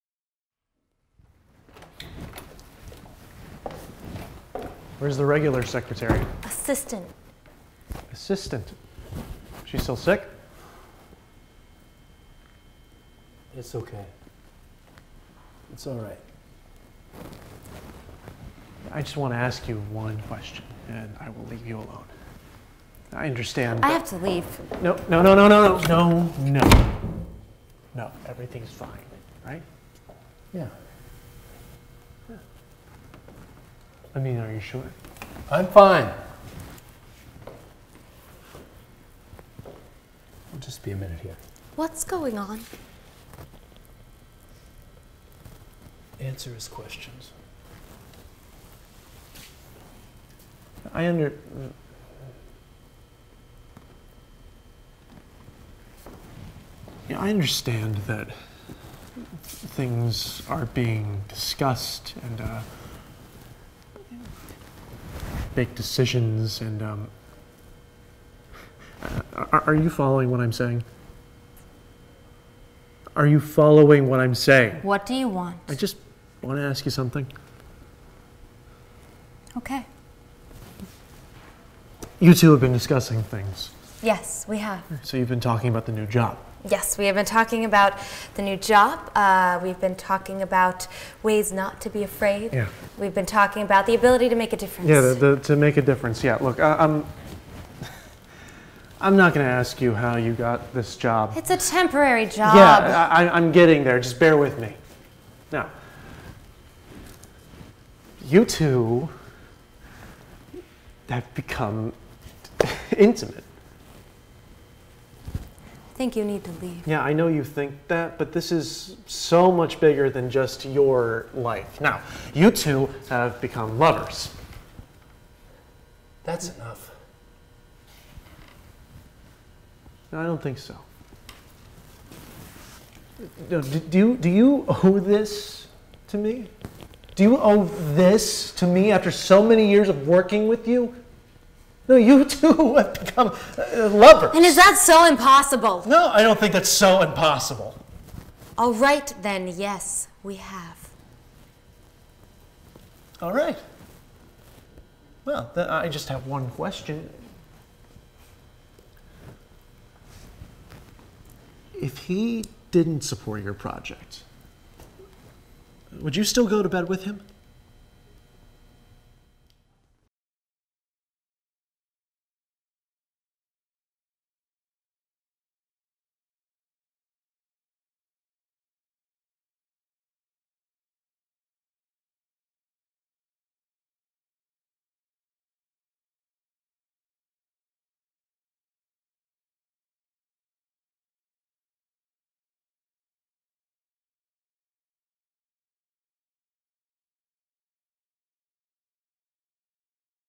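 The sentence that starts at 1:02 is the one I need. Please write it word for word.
Uh, make decisions and um, are, are you following what I'm saying?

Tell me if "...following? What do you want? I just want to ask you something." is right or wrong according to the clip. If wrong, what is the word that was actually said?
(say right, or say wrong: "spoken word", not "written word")
wrong: "saying", not "following".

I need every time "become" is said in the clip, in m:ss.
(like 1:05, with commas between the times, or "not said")
1:51, 2:03, 2:22.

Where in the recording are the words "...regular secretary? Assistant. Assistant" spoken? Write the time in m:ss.
0:05.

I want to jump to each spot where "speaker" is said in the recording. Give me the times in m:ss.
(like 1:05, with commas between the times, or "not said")
not said.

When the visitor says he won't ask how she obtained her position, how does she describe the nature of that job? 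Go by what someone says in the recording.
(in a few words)
temporary.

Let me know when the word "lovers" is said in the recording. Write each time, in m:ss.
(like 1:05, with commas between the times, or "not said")
2:03, 2:23.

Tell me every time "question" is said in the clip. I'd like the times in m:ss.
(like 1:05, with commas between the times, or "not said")
0:20, 0:46, 2:36.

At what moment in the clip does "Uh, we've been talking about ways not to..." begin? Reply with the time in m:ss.
1:29.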